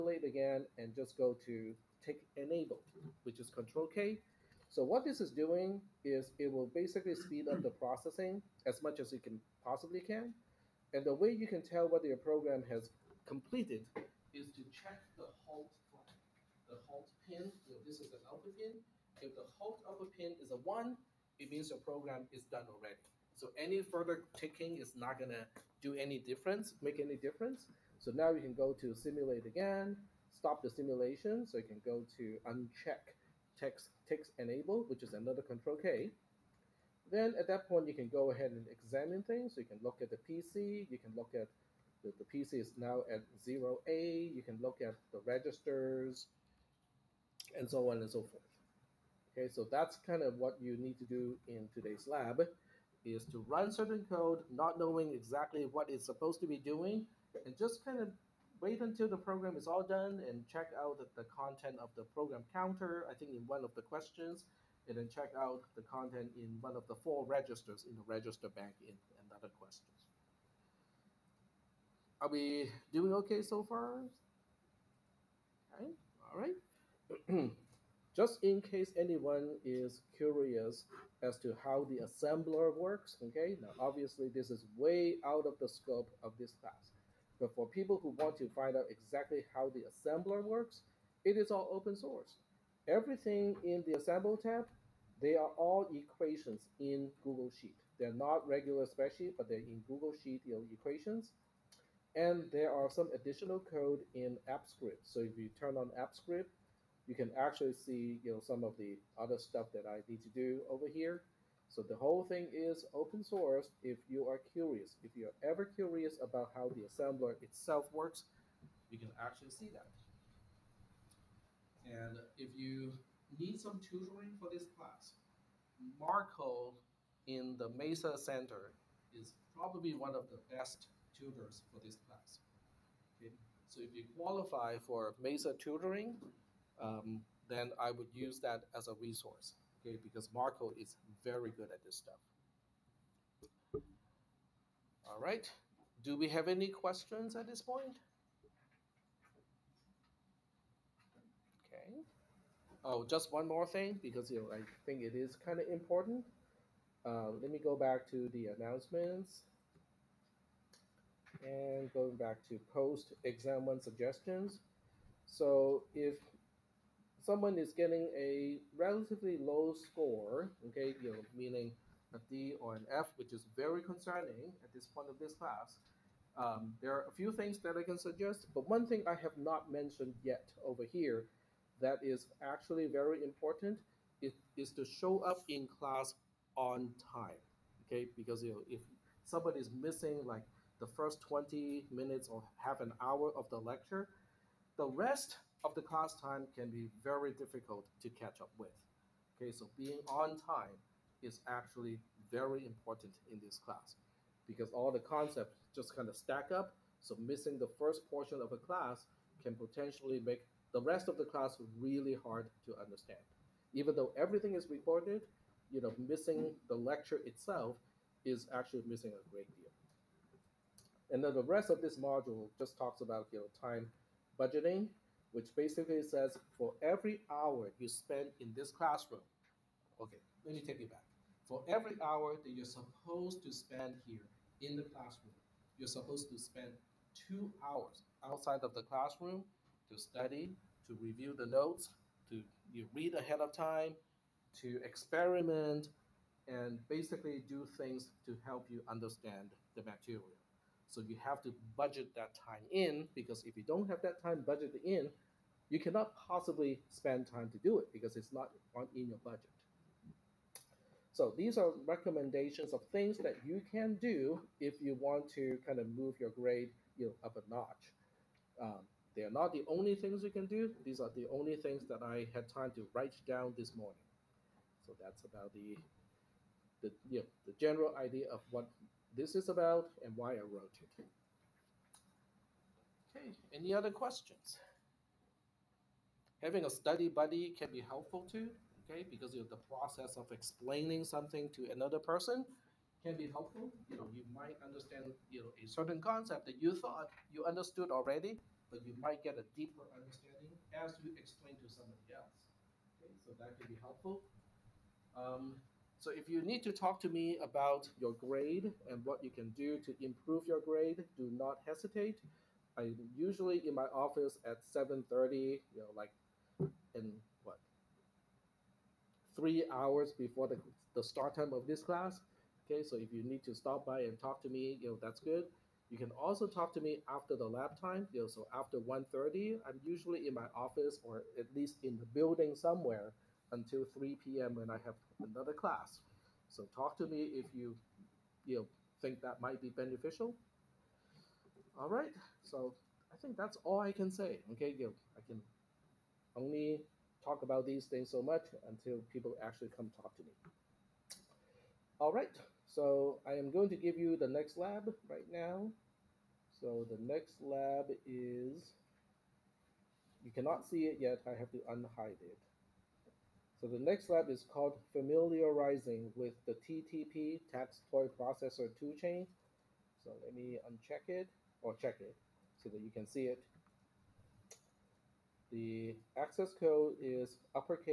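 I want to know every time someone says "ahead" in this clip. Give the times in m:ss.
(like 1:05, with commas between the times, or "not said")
0:38, 4:03.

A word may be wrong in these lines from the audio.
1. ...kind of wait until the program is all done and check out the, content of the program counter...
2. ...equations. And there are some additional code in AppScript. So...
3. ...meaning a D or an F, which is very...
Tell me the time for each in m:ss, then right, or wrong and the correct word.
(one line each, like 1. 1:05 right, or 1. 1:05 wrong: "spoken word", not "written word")
1. 0:57 right
2. 1:40 right
3. 2:51 right.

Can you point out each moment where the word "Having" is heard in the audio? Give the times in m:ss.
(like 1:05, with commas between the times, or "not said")
4:46.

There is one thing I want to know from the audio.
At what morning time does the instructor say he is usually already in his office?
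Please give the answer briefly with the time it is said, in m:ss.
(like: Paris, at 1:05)
7:30, at 5:14.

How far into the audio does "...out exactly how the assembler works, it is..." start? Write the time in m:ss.
1:28.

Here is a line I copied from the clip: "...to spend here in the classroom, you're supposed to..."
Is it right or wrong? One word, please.
right.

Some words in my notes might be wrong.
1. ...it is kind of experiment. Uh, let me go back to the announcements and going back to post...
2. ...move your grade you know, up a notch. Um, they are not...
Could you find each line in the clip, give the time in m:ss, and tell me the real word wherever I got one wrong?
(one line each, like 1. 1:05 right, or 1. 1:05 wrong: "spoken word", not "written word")
1. 2:35 wrong: "important", not "experiment"
2. 4:25 right.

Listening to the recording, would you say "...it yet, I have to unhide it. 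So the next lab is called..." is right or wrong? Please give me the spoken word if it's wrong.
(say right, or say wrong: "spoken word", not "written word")
right.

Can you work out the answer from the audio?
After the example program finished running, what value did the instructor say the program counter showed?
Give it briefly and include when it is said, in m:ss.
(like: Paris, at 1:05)
0A, at 0:43.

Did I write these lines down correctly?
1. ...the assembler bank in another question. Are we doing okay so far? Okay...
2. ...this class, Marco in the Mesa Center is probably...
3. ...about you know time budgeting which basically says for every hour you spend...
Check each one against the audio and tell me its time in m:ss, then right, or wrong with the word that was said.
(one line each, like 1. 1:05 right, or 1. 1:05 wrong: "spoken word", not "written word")
1. 1:07 wrong: "register", not "assembler"
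2. 2:04 right
3. 3:43 right.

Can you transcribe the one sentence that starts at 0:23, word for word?
So any further ticking is not gonna do any difference, make any difference.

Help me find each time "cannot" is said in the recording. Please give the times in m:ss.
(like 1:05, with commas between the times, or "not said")
4:15, 6:00.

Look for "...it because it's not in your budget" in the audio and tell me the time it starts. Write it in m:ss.
4:17.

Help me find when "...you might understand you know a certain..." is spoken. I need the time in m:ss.
4:54.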